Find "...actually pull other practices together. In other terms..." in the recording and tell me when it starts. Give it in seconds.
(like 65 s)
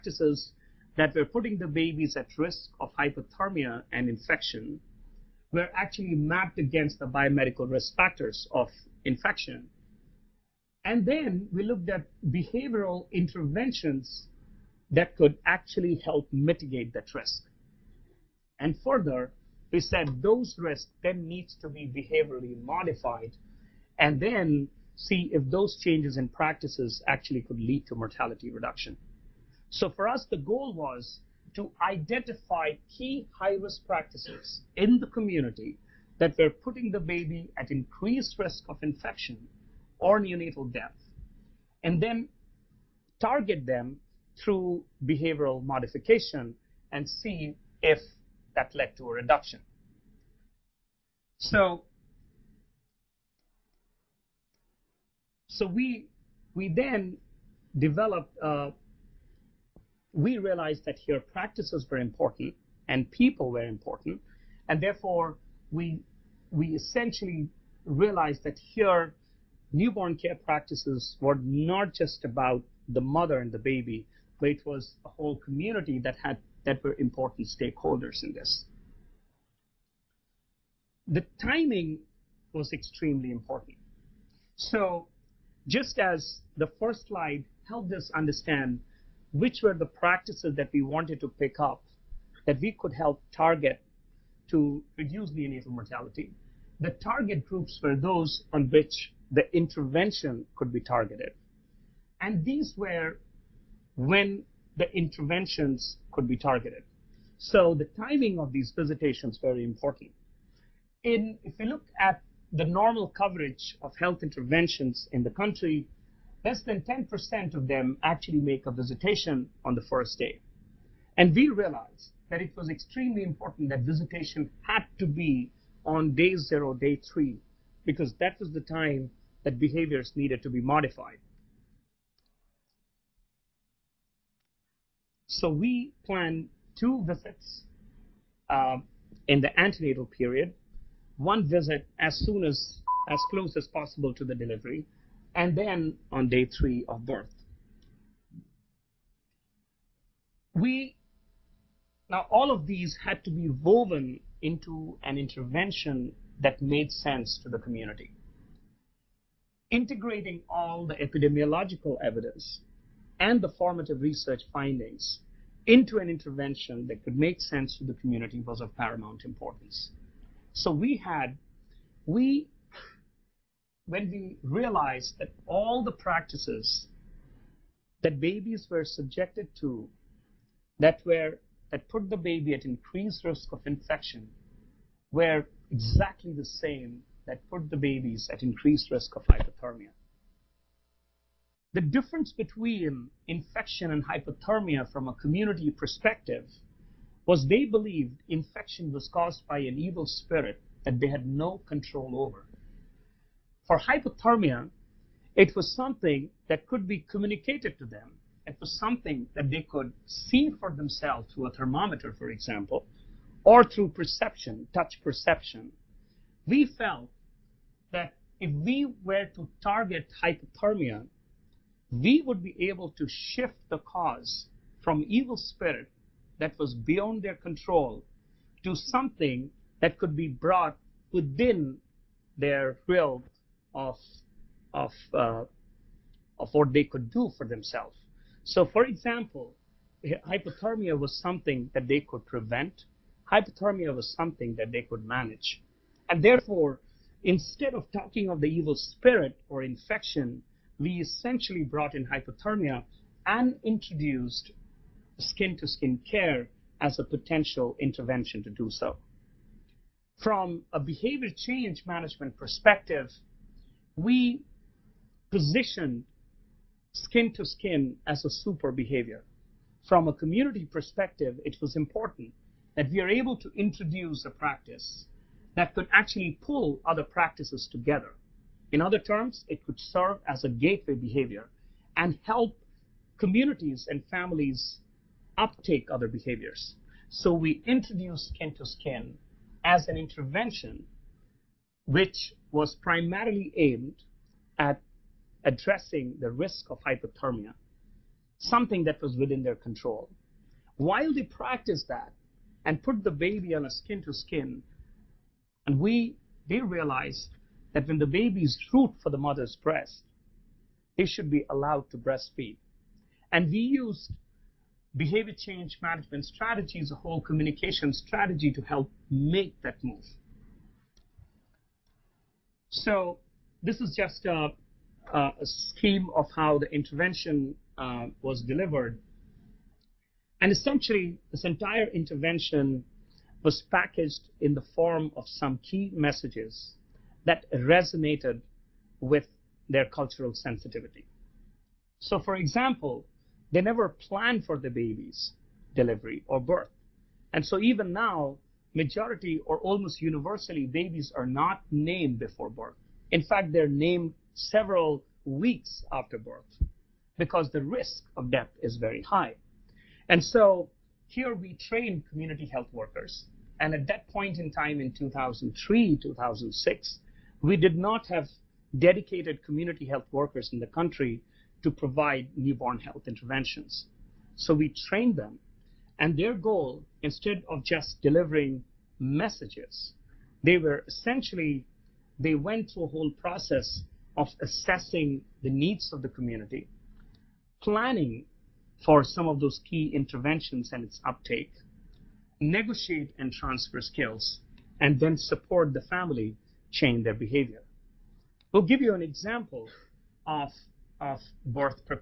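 275 s.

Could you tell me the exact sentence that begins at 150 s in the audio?
We, now all of these had to be woven into an intervention that made sense to the community.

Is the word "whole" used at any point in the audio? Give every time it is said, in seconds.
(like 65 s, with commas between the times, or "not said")
75 s, 316 s, 382 s.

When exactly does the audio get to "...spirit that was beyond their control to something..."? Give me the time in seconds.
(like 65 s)
225 s.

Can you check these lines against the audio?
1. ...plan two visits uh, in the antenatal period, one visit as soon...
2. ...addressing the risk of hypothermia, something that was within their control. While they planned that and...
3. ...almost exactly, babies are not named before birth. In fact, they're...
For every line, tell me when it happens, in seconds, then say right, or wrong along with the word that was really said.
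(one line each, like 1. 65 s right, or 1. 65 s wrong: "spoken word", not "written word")
1. 136 s right
2. 295 s wrong: "practiced", not "planned"
3. 349 s wrong: "universally", not "exactly".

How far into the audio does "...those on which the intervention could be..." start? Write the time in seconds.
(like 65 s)
97 s.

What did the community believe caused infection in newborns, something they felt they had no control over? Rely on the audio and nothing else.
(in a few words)
an evil spirit.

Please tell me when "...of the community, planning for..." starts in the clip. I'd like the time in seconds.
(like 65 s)
385 s.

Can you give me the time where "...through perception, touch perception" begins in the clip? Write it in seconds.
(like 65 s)
213 s.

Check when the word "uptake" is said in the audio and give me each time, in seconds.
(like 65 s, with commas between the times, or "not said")
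285 s, 391 s.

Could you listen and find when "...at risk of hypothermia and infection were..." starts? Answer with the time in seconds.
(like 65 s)
2 s.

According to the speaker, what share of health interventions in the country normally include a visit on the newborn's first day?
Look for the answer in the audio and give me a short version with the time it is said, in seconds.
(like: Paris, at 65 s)
less than 10%, at 116 s.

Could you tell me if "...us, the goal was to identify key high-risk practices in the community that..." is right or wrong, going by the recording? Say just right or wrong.
right.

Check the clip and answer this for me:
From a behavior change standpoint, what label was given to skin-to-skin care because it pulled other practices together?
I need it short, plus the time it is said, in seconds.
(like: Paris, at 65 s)
super behavior, at 268 s.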